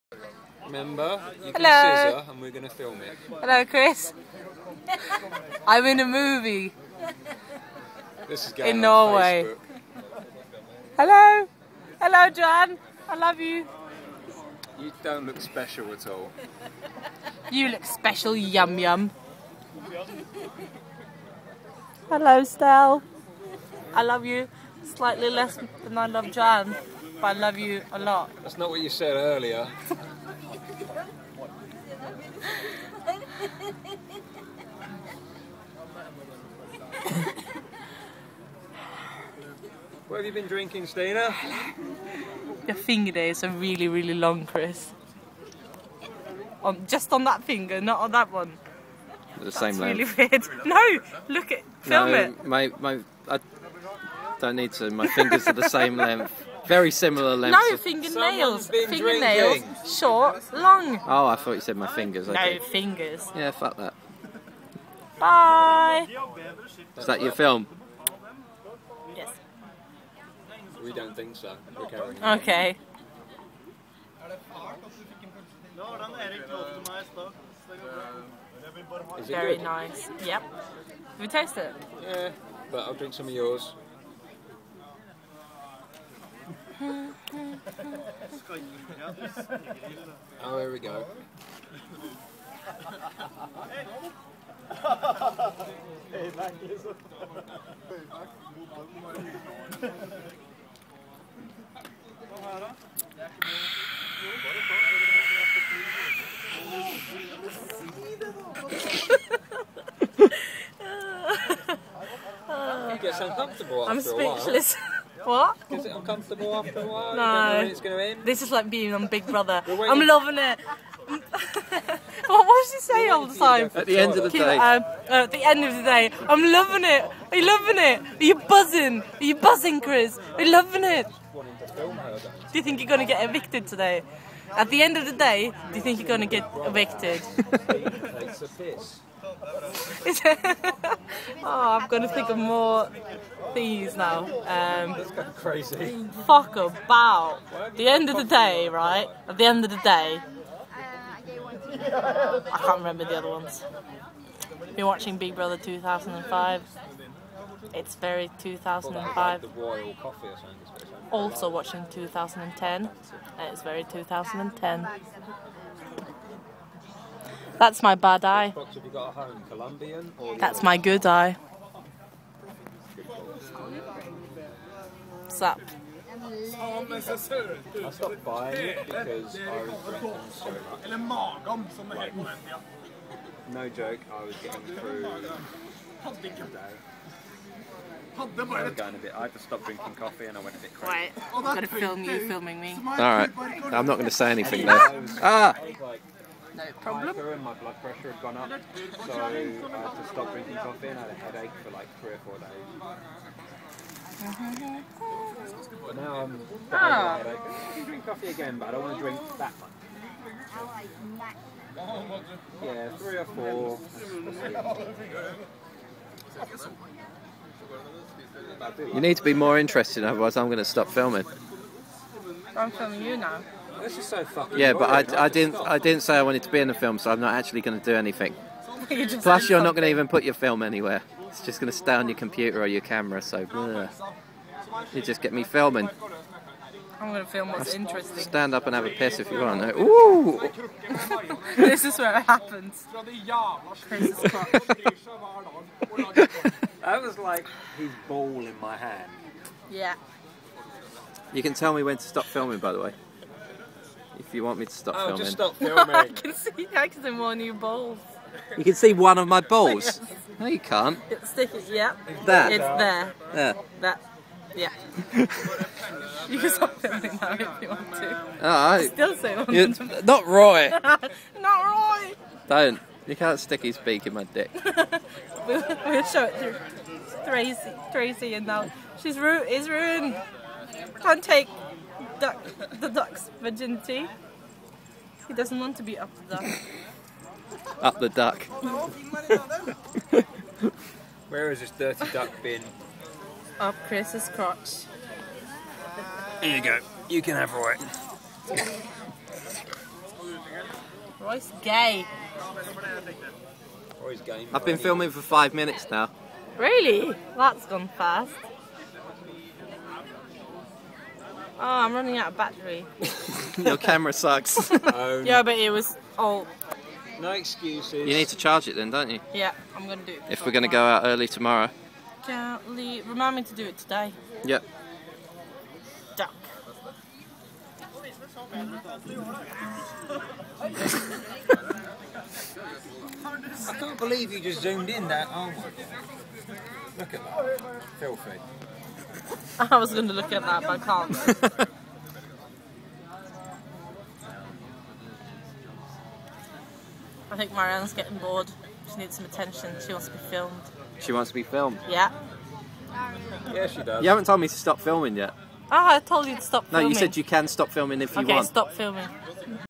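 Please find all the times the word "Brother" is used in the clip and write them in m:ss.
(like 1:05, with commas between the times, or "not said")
1:59, 2:35.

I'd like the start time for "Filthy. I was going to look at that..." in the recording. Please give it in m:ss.
5:37.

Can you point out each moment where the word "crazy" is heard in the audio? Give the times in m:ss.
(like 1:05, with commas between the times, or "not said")
2:25, 3:10.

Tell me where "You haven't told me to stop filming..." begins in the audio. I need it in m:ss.
5:54.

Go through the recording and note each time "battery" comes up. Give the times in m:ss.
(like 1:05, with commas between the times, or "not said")
5:12.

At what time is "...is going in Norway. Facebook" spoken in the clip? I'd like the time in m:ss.
0:08.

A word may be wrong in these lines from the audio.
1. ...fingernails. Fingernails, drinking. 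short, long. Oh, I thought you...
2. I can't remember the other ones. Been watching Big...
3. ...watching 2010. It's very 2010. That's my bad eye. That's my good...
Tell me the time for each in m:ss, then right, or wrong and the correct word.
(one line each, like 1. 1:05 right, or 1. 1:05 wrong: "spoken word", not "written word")
1. 0:57 right
2. 2:31 right
3. 2:41 right.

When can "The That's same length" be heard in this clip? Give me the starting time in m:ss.
0:49.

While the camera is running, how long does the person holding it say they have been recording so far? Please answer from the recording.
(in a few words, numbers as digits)
5 minutes.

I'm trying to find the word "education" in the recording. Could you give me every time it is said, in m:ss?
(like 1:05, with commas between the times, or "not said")
not said.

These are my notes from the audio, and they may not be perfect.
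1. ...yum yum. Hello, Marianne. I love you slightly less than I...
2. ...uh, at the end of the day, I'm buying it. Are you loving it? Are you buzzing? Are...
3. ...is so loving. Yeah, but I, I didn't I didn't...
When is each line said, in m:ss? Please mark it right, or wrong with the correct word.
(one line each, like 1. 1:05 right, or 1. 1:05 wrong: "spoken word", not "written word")
1. 0:18 wrong: "Stel", not "Marianne"
2. 2:05 wrong: "loving", not "buying"
3. 3:43 wrong: "fucking", not "loving".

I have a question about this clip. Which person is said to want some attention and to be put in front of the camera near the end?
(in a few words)
Marianne.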